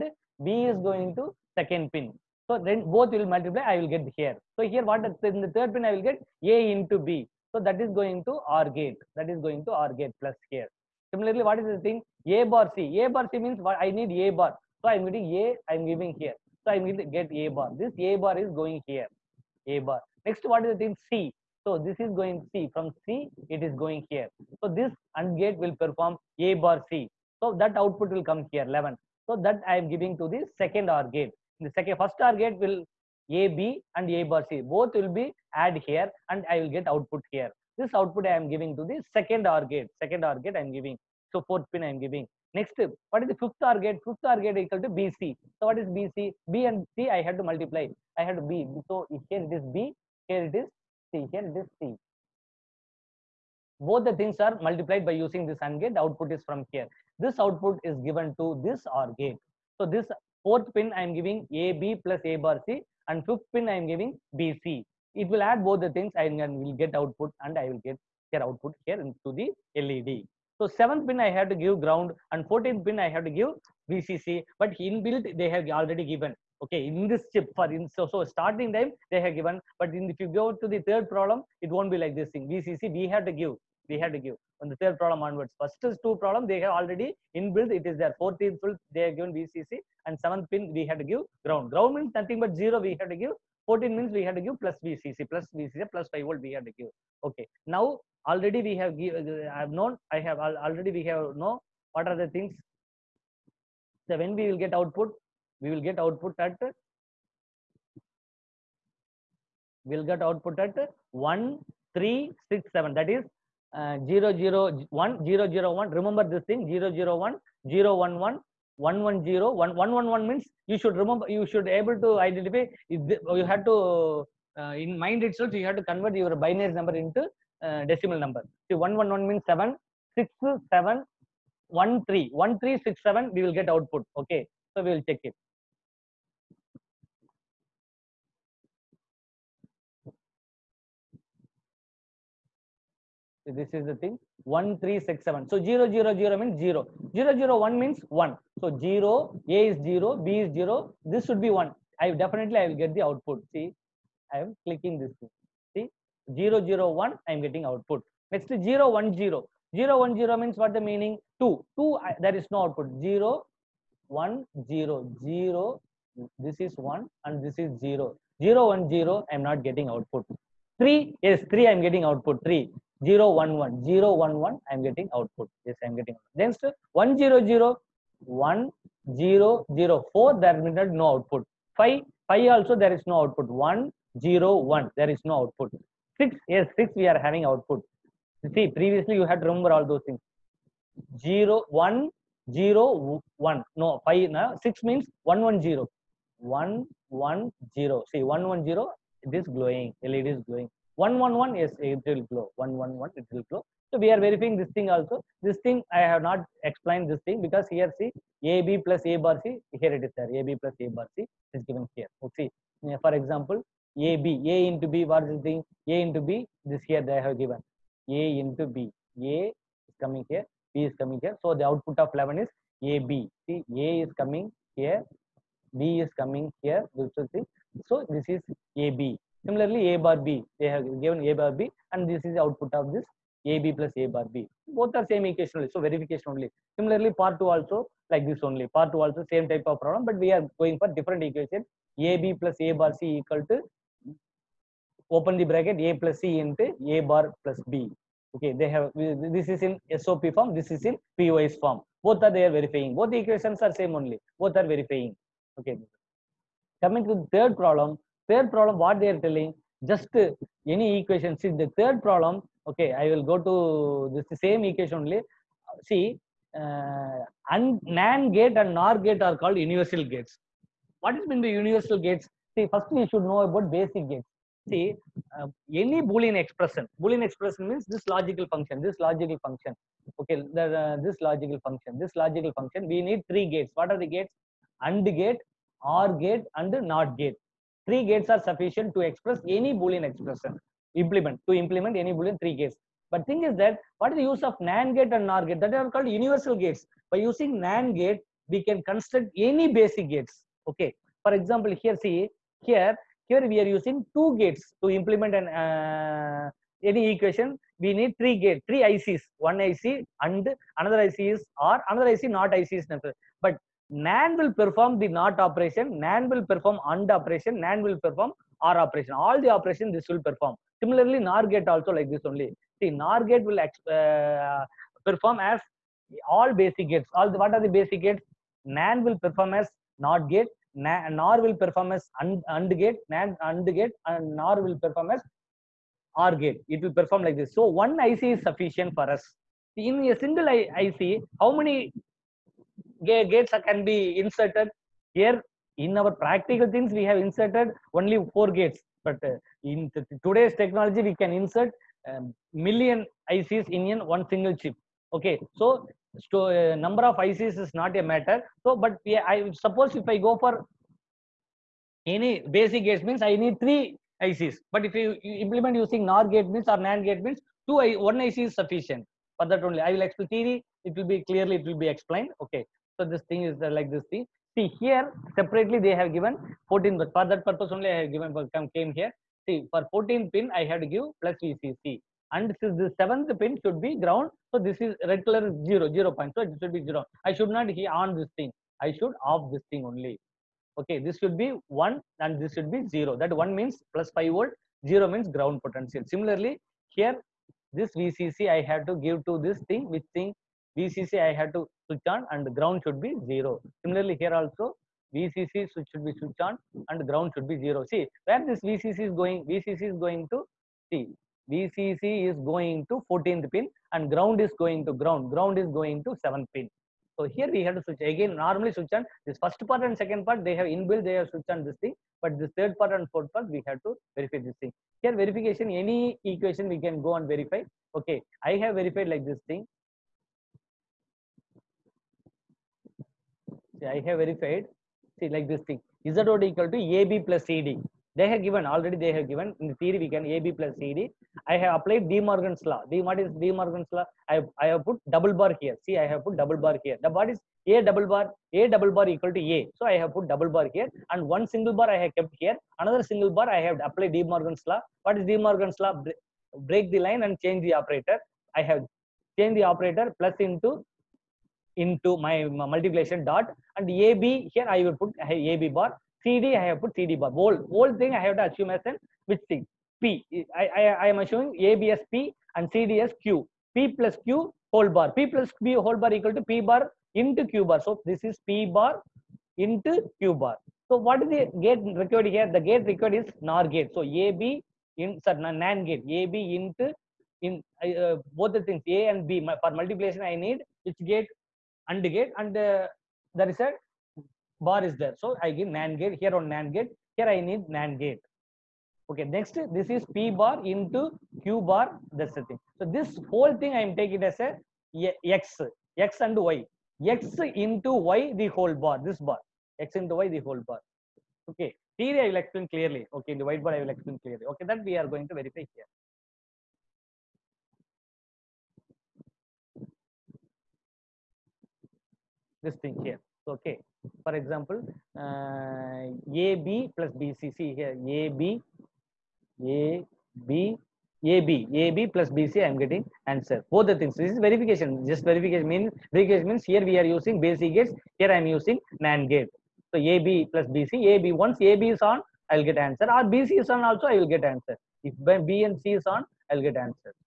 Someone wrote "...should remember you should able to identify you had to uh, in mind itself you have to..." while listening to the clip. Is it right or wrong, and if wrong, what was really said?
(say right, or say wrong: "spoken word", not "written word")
right.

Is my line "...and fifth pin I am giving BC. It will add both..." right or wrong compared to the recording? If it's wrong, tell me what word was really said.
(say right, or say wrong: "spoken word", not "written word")
right.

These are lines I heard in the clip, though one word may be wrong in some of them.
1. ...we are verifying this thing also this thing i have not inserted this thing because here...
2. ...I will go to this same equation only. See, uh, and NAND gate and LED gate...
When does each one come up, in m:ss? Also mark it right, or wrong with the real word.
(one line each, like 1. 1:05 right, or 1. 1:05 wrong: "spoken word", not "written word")
1. 3:24 wrong: "explained", not "inserted"
2. 4:22 wrong: "NOR", not "LED".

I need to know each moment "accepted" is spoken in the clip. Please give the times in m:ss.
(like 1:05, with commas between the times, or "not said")
not said.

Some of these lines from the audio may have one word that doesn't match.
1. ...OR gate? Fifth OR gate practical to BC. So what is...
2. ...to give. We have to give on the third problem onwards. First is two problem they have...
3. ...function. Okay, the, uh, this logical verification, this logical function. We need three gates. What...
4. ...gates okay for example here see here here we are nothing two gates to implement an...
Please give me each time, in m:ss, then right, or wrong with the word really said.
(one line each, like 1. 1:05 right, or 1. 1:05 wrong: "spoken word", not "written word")
1. 0:43 wrong: "equal", not "practical"
2. 1:23 right
3. 4:39 wrong: "function", not "verification"
4. 5:00 wrong: "using", not "nothing".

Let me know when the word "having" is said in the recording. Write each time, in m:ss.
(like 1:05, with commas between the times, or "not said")
3:07.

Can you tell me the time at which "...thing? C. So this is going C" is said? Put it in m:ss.
0:20.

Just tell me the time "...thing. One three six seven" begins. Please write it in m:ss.
2:23.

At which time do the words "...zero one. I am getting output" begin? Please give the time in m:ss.
2:36.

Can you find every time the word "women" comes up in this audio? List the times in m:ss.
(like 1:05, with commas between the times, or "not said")
not said.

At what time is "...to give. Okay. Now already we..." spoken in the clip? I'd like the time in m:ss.
1:36.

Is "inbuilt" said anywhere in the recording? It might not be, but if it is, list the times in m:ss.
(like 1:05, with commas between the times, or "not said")
1:14, 1:27, 7:00.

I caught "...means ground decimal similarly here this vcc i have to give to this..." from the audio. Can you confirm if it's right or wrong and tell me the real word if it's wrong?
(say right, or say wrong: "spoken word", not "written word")
wrong: "potential", not "decimal".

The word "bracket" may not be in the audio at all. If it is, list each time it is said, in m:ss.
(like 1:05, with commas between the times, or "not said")
4:05.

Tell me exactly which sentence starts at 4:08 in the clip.
Okay, they have this is in SOP form, this is in POS form.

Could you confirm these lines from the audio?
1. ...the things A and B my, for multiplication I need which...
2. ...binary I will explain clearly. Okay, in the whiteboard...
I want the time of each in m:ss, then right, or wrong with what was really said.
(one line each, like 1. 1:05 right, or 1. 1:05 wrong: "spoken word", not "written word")
1. 8:08 right
2. 8:31 wrong: "theory", not "binary".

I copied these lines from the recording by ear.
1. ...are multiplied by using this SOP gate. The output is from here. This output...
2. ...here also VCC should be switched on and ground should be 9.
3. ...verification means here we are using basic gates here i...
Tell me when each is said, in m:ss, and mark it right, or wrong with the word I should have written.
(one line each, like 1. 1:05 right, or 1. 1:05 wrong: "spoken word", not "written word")
1. 0:54 wrong: "AND", not "SOP"
2. 6:44 wrong: "0", not "9"
3. 8:56 right.